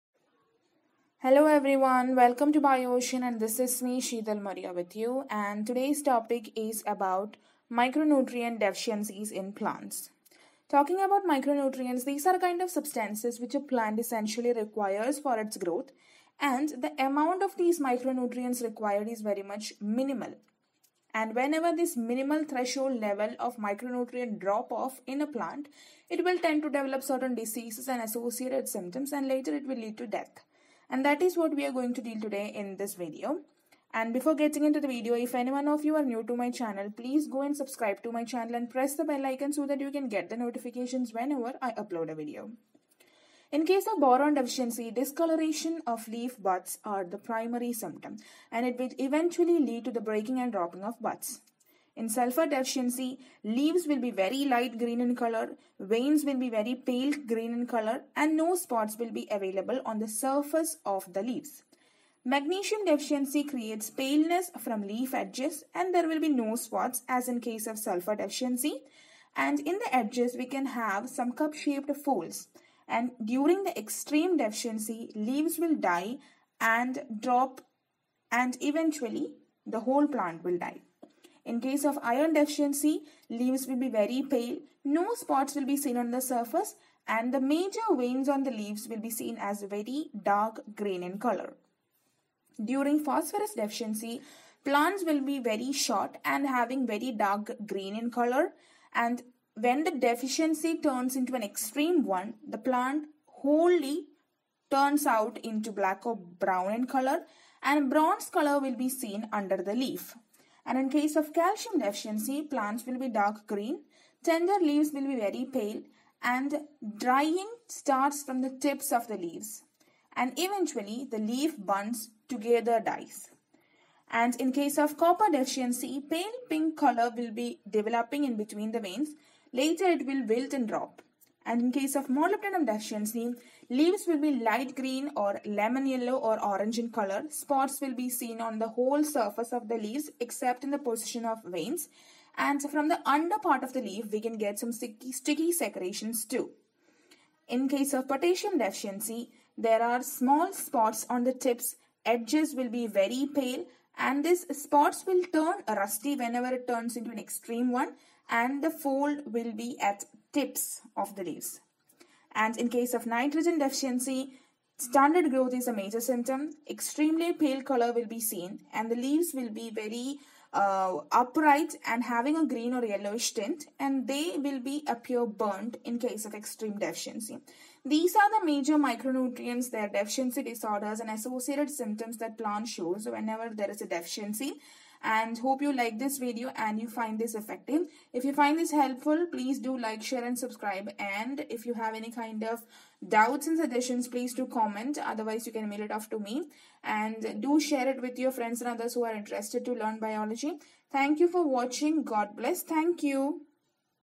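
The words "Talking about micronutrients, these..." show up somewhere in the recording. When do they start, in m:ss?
0:10.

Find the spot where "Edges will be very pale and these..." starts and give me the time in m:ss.
2:32.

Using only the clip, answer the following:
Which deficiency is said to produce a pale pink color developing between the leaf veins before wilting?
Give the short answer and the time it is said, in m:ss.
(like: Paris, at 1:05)
Copper, at 2:04.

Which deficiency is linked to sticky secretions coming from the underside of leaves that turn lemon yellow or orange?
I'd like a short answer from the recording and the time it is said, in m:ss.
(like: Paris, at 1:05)
Molybdenum, at 2:12.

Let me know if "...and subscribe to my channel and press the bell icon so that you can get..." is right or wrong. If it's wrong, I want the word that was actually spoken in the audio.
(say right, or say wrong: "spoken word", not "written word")
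right.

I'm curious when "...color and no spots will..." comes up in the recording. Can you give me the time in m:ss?
0:57.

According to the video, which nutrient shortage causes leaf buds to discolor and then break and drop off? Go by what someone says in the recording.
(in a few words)
Boron.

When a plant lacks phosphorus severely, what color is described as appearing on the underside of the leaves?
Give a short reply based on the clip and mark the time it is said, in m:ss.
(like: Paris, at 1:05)
Bronze, at 1:47.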